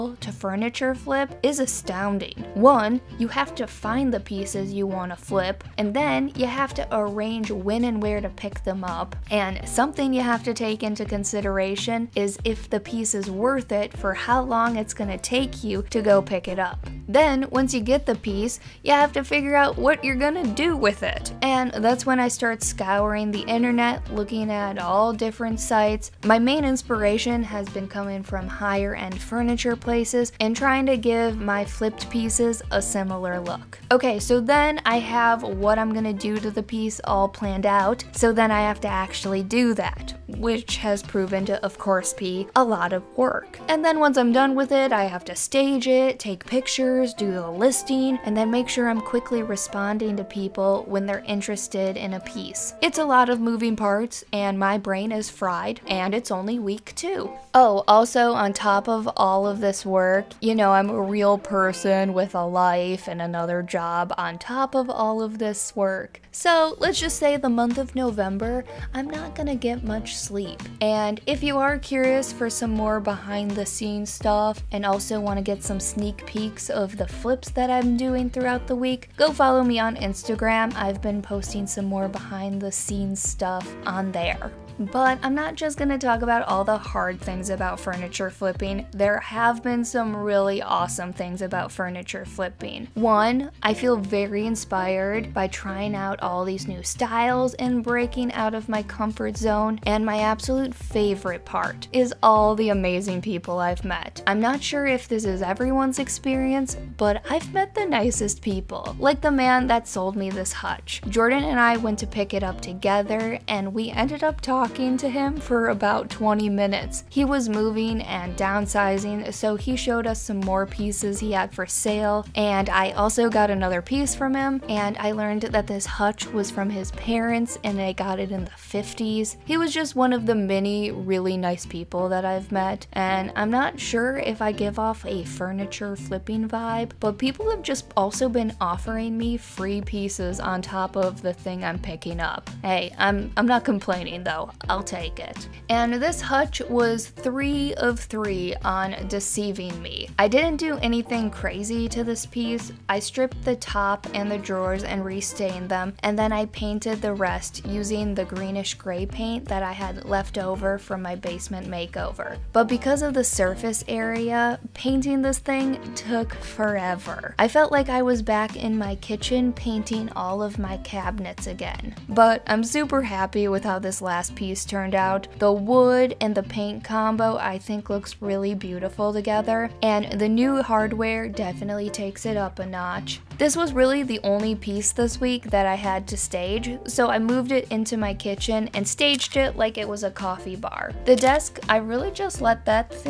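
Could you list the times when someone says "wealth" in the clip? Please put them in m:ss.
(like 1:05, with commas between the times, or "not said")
not said.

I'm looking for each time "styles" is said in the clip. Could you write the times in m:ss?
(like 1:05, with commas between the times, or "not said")
1:36.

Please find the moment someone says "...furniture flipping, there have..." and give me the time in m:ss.
1:27.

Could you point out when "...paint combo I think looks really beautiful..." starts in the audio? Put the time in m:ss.
2:56.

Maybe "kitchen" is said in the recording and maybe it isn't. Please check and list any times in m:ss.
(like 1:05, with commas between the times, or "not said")
2:48, 3:08.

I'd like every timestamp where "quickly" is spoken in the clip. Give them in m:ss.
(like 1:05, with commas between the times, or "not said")
0:49.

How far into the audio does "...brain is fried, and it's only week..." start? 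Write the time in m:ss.
0:54.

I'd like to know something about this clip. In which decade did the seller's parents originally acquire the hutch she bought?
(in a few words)
The 50s.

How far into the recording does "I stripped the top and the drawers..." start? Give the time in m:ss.
2:32.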